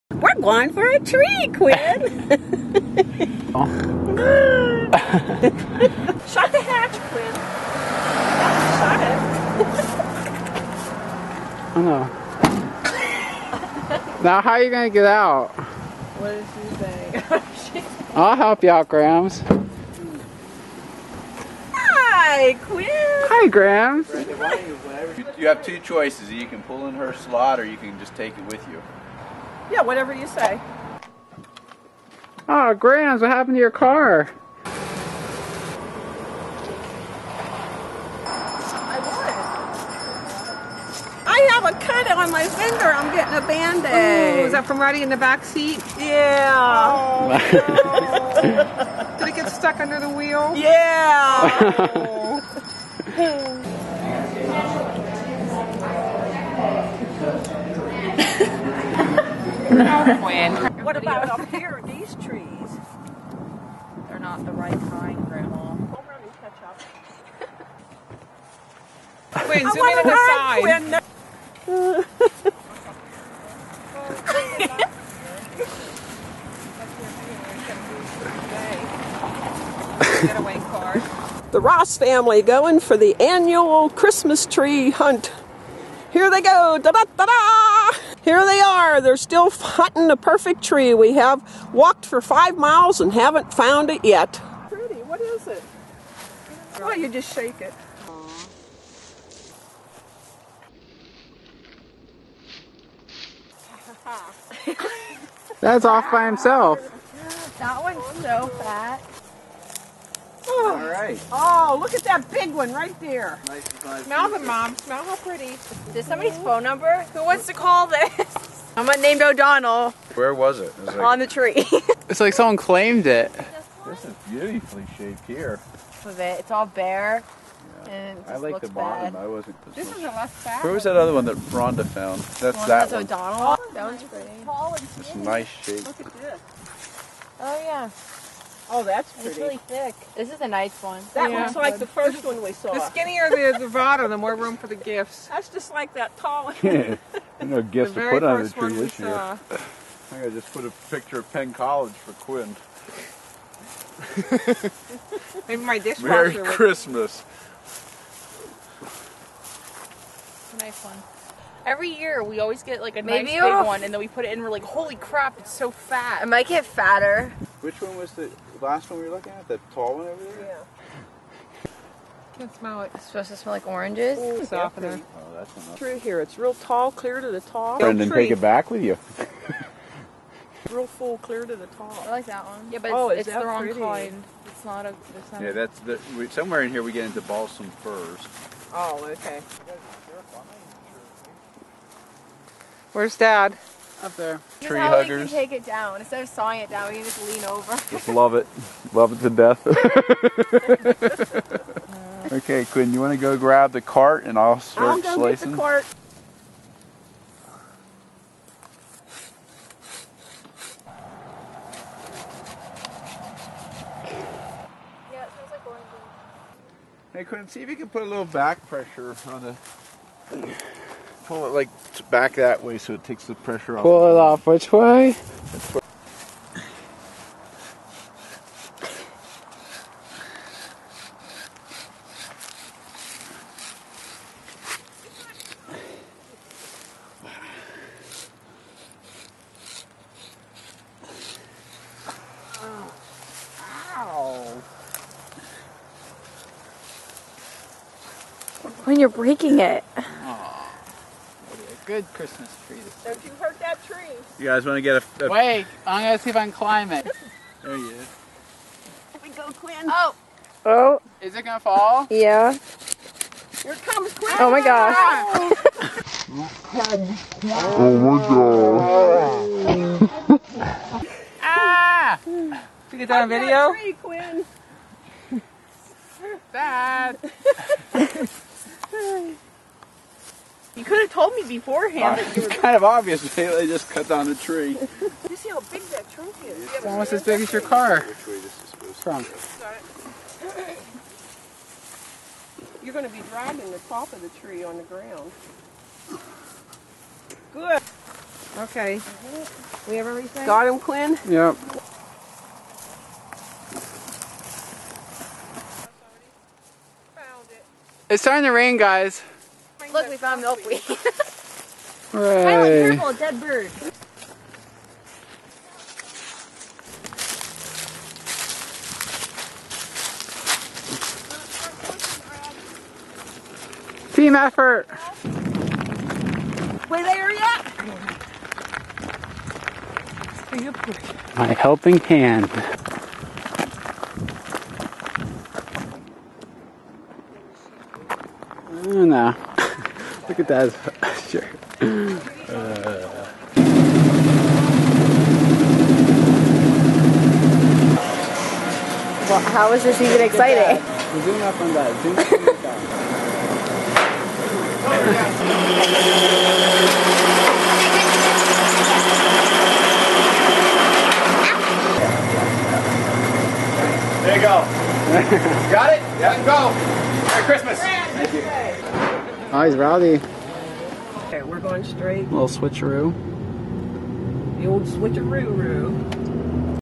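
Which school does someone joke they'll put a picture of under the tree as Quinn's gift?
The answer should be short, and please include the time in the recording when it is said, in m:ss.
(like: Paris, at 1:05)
Penn College, at 2:31.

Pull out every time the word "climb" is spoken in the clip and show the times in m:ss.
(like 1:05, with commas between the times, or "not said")
4:16.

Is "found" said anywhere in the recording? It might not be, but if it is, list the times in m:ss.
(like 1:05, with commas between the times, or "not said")
1:33, 2:11, 5:10.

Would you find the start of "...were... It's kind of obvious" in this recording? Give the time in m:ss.
4:42.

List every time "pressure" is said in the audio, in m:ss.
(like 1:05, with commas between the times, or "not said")
3:38, 3:43.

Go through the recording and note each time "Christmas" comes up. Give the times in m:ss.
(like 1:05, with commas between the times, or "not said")
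1:23, 2:36, 4:12, 6:07.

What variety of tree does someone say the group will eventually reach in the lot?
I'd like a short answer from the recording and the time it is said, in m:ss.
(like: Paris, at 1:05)
Balsam firs, at 3:07.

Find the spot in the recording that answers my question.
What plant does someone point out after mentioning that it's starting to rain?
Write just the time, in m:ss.
5:10.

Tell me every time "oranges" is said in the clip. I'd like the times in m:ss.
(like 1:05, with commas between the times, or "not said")
2:53.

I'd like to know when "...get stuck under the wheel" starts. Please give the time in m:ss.
0:49.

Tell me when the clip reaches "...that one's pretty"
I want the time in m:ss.
2:13.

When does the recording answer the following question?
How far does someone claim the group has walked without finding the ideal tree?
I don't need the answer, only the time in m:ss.
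1:32.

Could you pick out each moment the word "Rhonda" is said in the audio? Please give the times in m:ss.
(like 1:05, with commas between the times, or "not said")
2:11.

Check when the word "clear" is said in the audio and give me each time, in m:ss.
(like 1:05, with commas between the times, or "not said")
2:56, 3:01.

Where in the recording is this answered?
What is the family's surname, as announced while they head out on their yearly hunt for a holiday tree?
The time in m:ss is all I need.
1:21.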